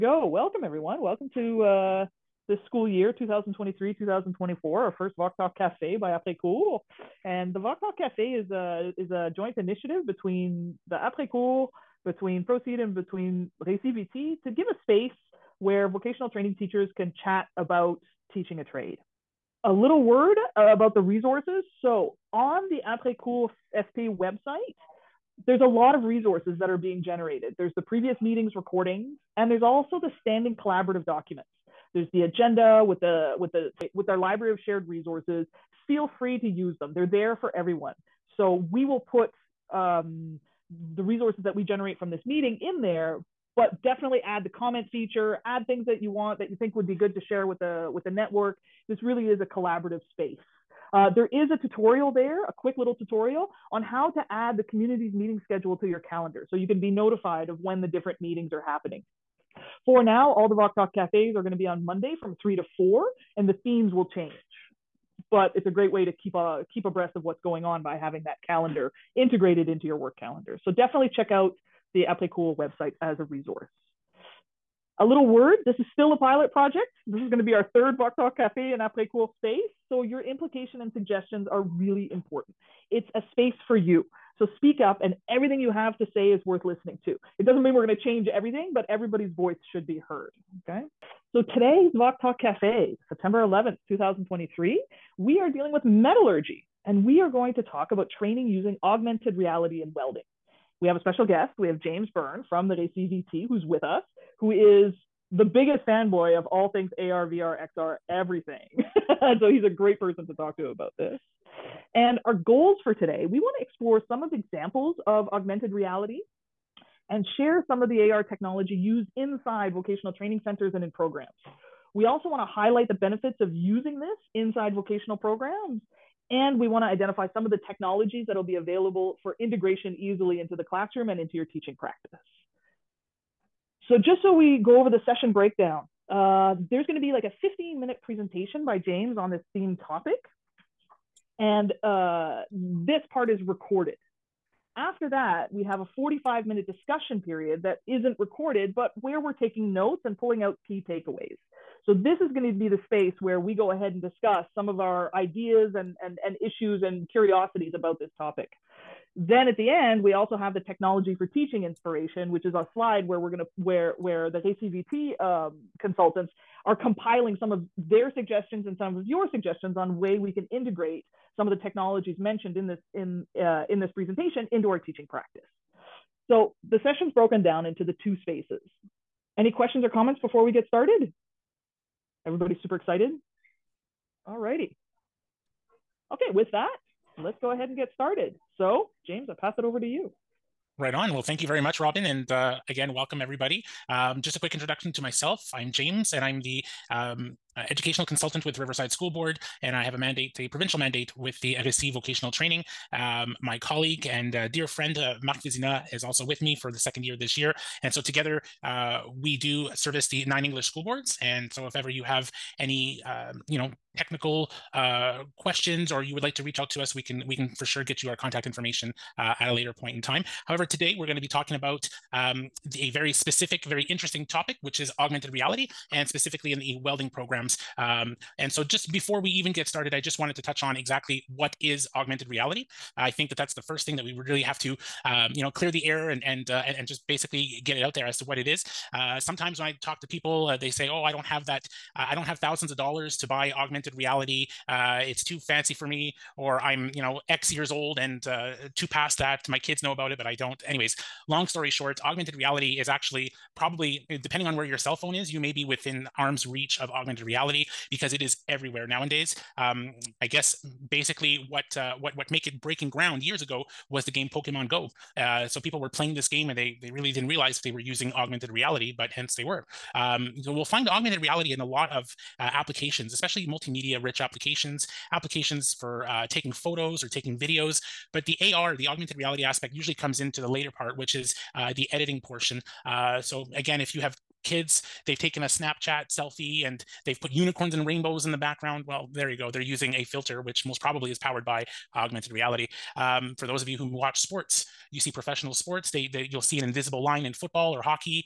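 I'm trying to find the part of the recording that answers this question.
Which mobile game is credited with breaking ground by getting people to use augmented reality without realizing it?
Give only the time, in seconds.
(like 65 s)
264 s.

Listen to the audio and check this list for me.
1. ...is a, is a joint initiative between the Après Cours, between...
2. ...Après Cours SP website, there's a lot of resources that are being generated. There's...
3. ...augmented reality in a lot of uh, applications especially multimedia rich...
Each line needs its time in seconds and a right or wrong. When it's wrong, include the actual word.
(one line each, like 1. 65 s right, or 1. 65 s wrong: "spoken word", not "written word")
1. 8 s right
2. 22 s right
3. 270 s right.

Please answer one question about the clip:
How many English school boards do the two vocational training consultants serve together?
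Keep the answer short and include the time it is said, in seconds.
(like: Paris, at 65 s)
9, at 210 s.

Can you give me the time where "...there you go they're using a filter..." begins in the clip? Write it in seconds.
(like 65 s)
289 s.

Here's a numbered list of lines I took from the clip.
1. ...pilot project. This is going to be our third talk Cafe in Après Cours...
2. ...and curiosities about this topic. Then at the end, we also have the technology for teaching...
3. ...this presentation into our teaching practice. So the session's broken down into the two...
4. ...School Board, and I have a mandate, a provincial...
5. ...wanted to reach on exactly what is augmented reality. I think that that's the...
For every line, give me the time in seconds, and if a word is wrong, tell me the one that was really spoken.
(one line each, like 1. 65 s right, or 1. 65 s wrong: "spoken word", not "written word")
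1. 76 s right
2. 156 s right
3. 173 s right
4. 198 s right
5. 230 s wrong: "touch", not "reach".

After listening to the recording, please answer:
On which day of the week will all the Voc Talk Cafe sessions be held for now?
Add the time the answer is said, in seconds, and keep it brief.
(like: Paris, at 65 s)
Monday, at 61 s.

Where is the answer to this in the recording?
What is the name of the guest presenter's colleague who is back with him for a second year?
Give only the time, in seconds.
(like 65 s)
205 s.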